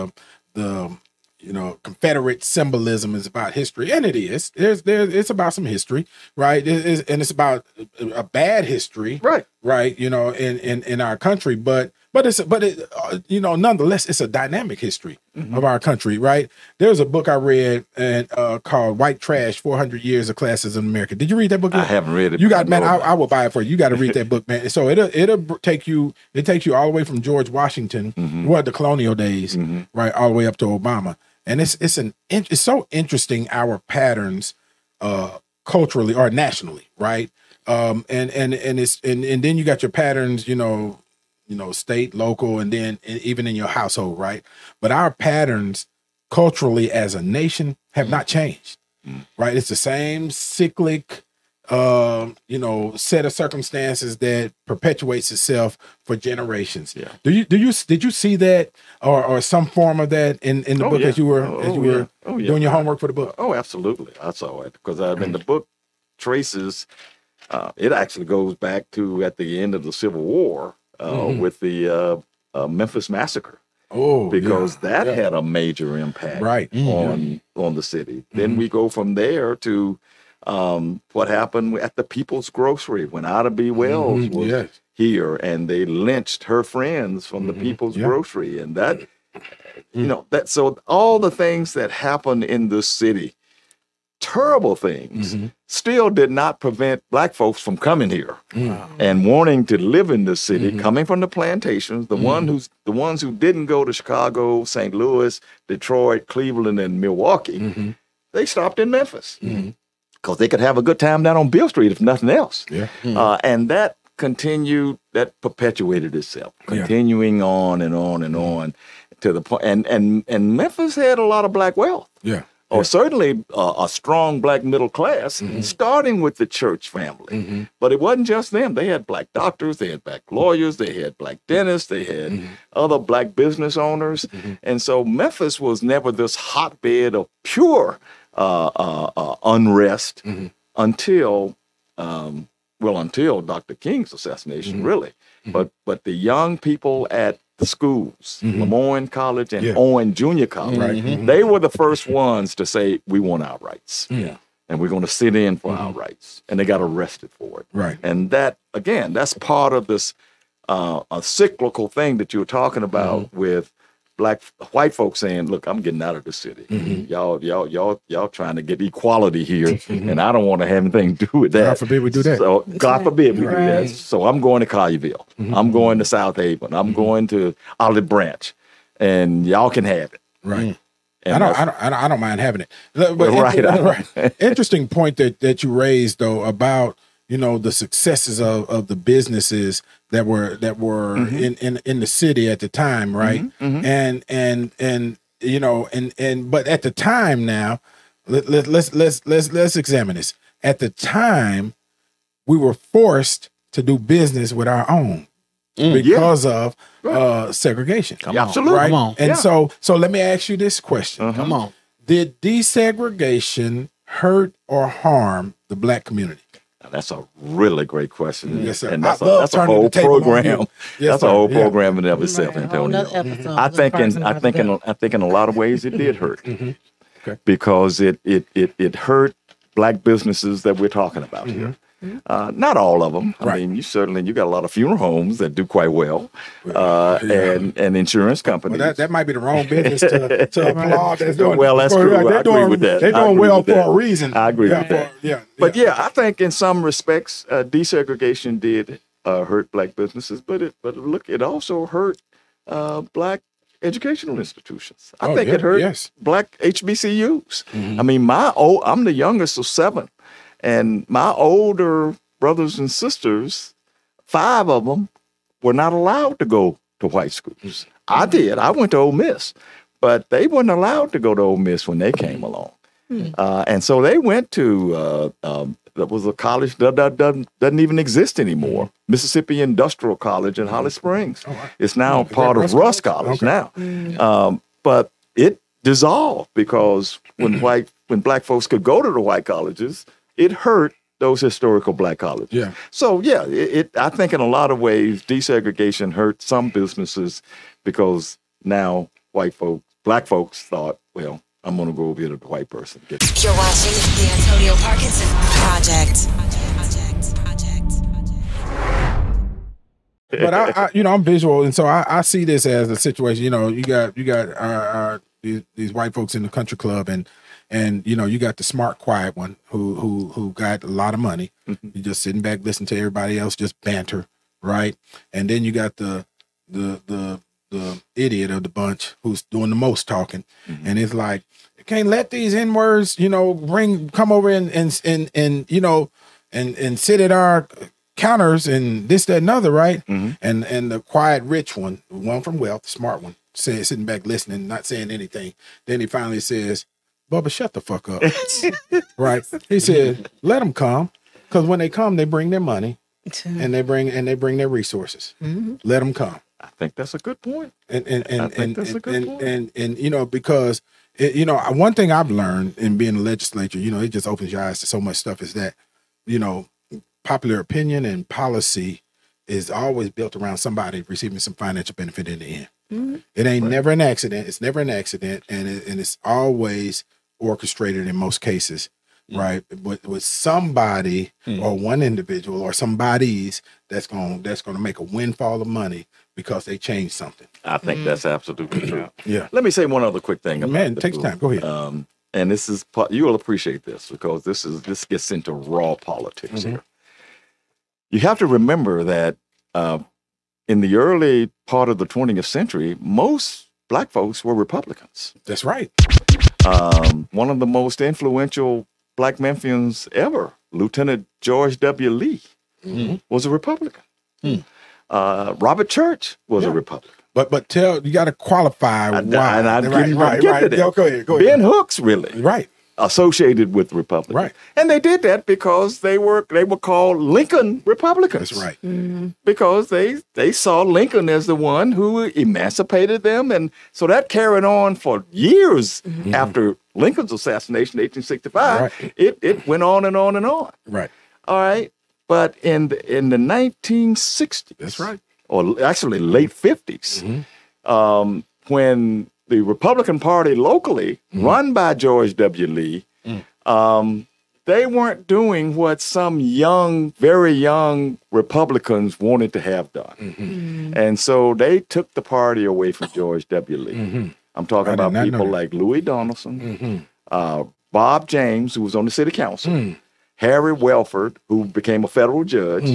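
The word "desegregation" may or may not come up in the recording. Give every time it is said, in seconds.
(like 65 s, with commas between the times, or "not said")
212 s, 247 s, 295 s.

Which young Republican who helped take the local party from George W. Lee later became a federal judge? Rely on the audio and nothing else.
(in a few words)
Harry Wellford.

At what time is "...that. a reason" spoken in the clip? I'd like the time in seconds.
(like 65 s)
243 s.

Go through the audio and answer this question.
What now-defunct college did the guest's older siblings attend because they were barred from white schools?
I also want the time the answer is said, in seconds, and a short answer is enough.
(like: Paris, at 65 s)
Mississippi Industrial College, at 279 s.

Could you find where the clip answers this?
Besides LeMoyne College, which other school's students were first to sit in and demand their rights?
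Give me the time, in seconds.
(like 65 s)
149 s.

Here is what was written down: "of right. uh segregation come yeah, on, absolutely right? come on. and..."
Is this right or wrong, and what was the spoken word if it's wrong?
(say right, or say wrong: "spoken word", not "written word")
right.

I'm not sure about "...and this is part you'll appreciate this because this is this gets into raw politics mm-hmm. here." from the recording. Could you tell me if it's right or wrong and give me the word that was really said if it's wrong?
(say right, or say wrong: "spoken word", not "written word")
right.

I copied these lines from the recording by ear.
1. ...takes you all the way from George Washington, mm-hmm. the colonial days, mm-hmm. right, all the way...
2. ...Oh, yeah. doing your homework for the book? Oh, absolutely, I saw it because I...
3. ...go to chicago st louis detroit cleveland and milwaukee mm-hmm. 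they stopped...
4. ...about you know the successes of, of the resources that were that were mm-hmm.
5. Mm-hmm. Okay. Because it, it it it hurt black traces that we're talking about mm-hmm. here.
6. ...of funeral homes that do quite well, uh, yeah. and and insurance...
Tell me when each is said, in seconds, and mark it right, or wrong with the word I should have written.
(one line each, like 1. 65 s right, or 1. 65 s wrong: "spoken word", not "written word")
1. 26 s right
2. 62 s right
3. 103 s right
4. 186 s wrong: "businesses", not "resources"
5. 226 s wrong: "businesses", not "traces"
6. 234 s right.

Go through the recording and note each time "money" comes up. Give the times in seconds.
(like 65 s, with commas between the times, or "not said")
321 s, 352 s, 385 s.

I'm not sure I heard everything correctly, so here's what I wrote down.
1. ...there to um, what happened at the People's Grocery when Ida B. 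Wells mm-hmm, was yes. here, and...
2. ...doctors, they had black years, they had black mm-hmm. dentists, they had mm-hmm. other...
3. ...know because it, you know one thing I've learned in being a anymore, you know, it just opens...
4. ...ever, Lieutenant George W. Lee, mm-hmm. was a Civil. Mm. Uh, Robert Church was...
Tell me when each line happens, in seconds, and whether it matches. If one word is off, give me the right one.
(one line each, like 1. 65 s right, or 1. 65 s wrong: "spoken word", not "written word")
1. 79 s right
2. 129 s wrong: "lawyers", not "years"
3. 360 s wrong: "legislature", not "anymore"
4. 410 s wrong: "Republican", not "Civil".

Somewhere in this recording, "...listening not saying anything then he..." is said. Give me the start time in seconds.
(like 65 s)
344 s.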